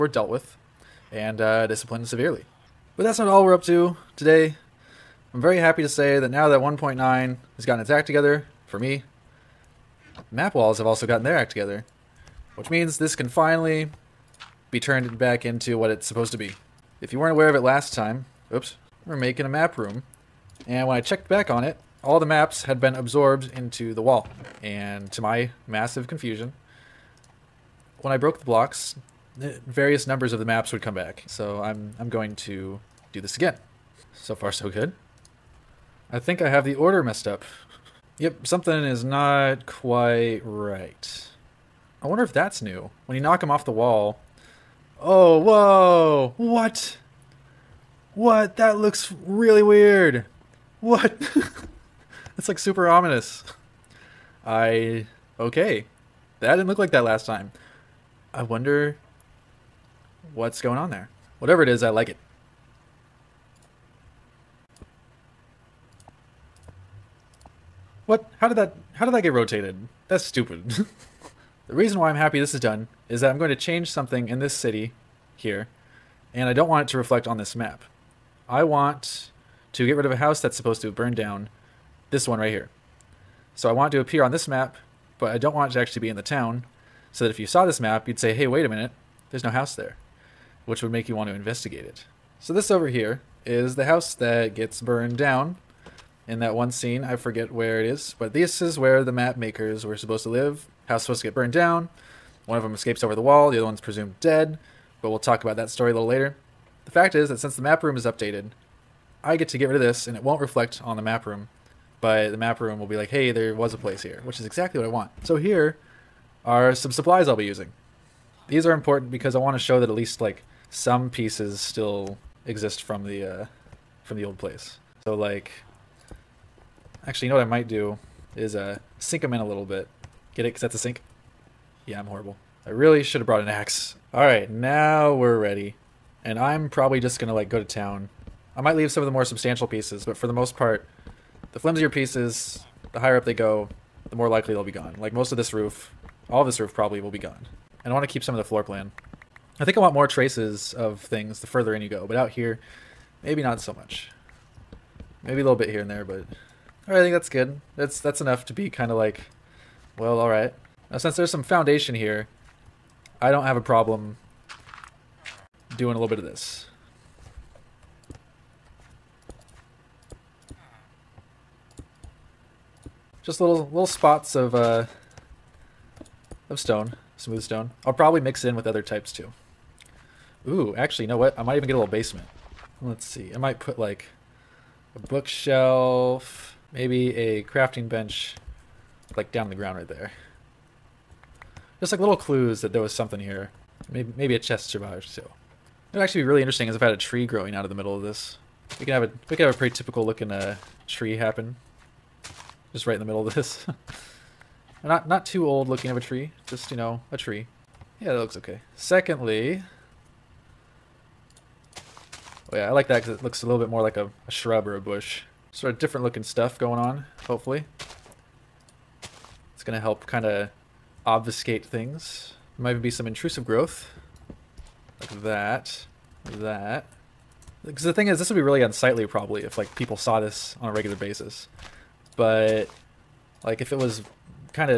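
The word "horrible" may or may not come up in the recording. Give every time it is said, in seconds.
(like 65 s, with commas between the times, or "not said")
132 s.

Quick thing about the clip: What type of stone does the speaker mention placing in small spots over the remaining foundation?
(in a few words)
smooth stone.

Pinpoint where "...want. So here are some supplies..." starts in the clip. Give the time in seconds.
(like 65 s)
114 s.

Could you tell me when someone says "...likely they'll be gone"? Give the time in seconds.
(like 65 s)
144 s.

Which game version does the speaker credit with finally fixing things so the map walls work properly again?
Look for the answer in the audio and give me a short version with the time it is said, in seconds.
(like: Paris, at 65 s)
1.9, at 6 s.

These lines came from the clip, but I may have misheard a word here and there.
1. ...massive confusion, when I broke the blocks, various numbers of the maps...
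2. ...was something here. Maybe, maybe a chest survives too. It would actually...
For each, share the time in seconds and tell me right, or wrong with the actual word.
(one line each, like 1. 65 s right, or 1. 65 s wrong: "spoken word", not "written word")
1. 25 s right
2. 192 s right.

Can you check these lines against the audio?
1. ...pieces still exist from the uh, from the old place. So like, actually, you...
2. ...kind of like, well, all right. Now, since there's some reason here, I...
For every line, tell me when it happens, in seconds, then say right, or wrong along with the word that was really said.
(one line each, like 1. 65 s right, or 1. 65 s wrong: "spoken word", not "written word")
1. 121 s right
2. 158 s wrong: "foundation", not "reason".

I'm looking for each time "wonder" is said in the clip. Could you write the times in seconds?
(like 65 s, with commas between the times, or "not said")
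42 s, 58 s.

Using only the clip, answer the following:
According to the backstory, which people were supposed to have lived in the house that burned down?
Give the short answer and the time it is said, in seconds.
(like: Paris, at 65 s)
the map makers, at 99 s.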